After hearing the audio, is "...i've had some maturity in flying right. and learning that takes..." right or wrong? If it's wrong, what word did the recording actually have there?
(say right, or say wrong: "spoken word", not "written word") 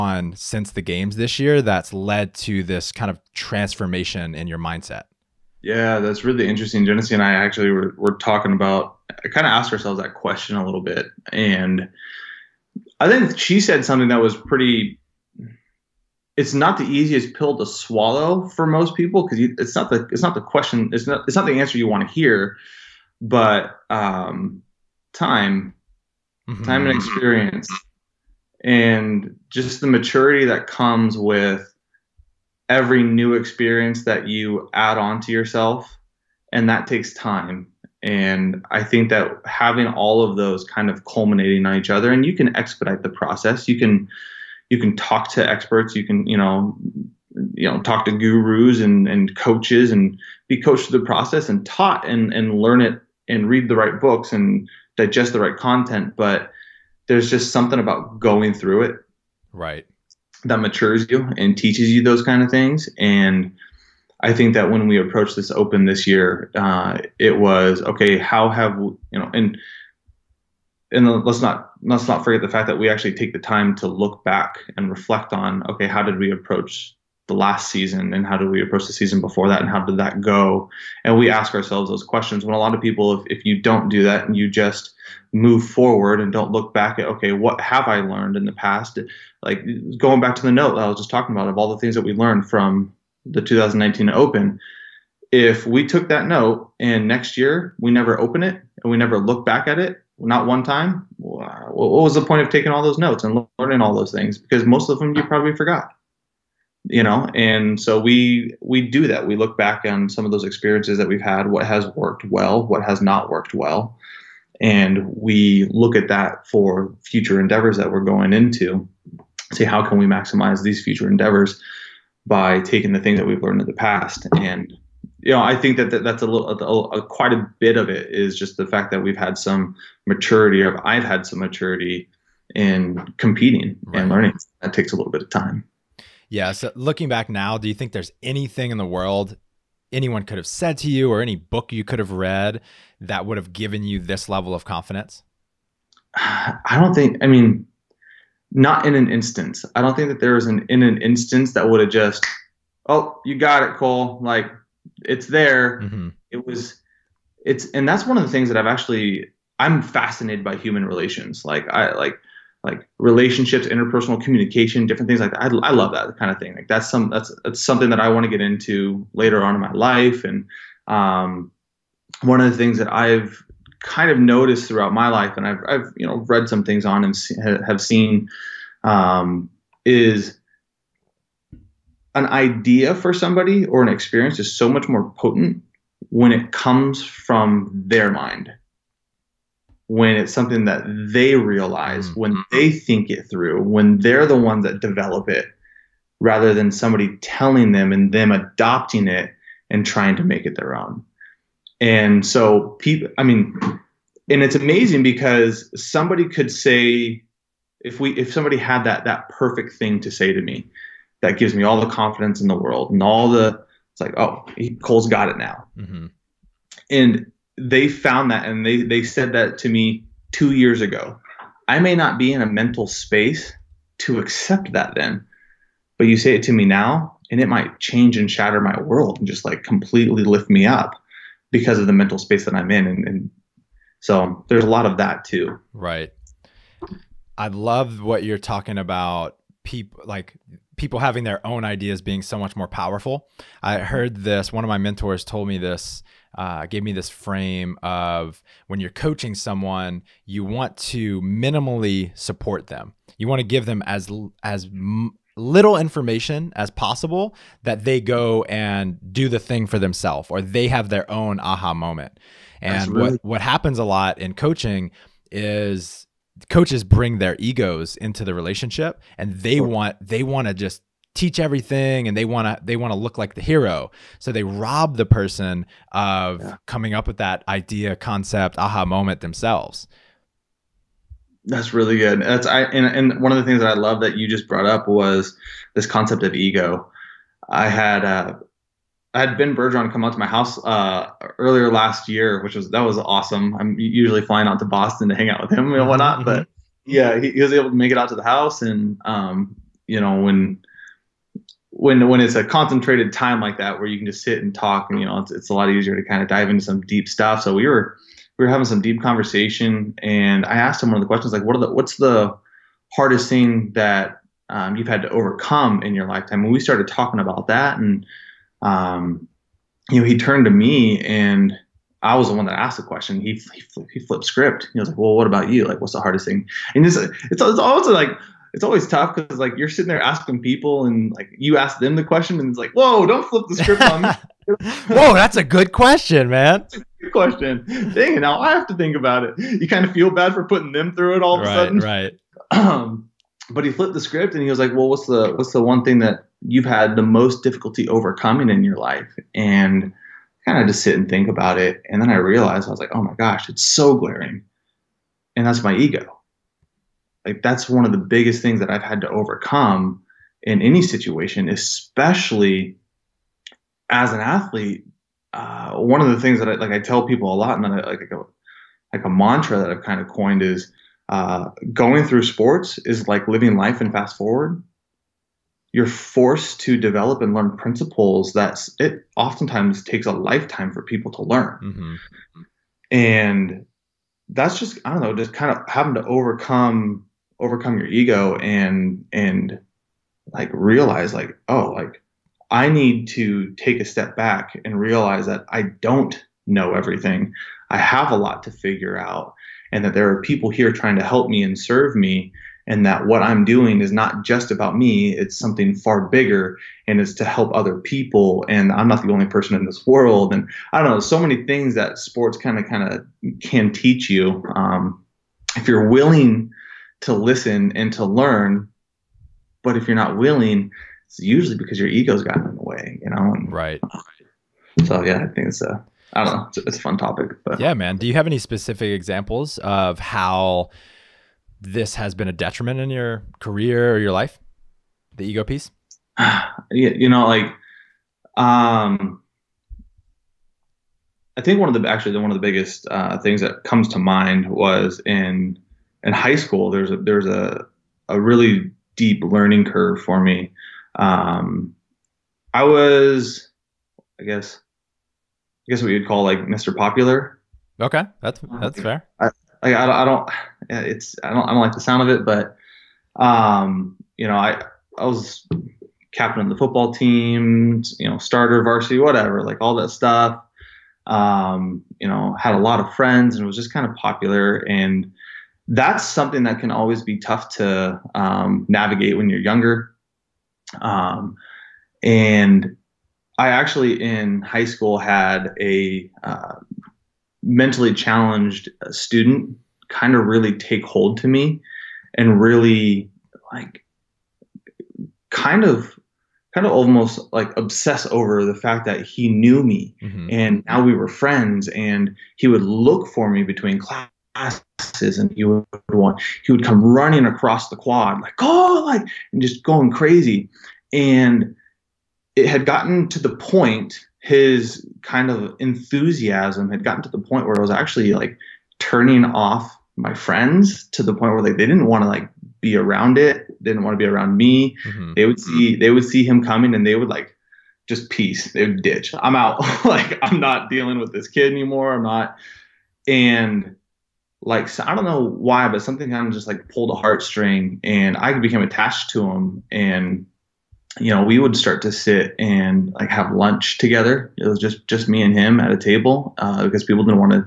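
wrong: "competing", not "flying".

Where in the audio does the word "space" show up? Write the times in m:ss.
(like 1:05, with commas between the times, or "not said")
3:42, 3:52.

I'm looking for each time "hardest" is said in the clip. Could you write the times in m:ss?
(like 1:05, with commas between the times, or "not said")
5:12, 5:25.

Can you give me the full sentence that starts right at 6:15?
You're forced to develop and learn principles that it oftentimes takes a lifetime for people to learn, mm-hmm.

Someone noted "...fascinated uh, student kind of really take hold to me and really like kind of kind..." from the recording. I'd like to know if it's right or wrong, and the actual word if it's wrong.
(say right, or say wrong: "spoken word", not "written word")
wrong: "challenged", not "fascinated".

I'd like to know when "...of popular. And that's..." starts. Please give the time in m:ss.
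7:53.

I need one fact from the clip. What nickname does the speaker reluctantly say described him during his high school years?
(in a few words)
Mr. Popular.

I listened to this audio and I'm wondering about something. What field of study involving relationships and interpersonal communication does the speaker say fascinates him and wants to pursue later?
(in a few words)
Human relations.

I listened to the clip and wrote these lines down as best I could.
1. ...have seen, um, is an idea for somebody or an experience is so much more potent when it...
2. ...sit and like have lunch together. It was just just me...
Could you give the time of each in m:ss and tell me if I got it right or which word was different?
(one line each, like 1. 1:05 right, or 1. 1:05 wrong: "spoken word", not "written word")
1. 2:57 right
2. 9:01 right.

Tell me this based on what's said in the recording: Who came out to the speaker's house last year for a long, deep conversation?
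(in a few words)
Ben Bergeron.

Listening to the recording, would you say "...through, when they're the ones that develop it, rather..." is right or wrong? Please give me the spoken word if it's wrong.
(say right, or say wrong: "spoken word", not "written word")
right.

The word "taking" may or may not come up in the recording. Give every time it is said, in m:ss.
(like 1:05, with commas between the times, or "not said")
1:42, 2:02.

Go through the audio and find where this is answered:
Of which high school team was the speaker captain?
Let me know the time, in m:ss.
7:46.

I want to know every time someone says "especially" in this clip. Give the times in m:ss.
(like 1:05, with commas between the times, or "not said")
6:01.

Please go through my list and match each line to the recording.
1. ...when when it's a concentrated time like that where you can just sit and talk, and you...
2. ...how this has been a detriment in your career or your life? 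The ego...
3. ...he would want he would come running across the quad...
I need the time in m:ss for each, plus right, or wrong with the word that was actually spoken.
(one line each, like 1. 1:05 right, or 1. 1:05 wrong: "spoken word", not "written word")
1. 5:01 right
2. 7:09 right
3. 8:25 right.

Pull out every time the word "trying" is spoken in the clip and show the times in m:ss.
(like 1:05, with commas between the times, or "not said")
3:19, 6:40.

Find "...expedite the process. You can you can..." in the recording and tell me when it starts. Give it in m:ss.
0:42.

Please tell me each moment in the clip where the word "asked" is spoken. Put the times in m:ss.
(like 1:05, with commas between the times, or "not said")
0:09, 5:10, 5:22.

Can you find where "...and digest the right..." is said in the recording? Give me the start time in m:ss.
0:54.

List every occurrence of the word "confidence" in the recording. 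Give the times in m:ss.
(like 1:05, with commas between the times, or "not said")
2:24, 3:31.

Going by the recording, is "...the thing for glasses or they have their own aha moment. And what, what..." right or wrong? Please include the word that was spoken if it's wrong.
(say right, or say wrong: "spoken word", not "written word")
wrong: "themselves", not "glasses".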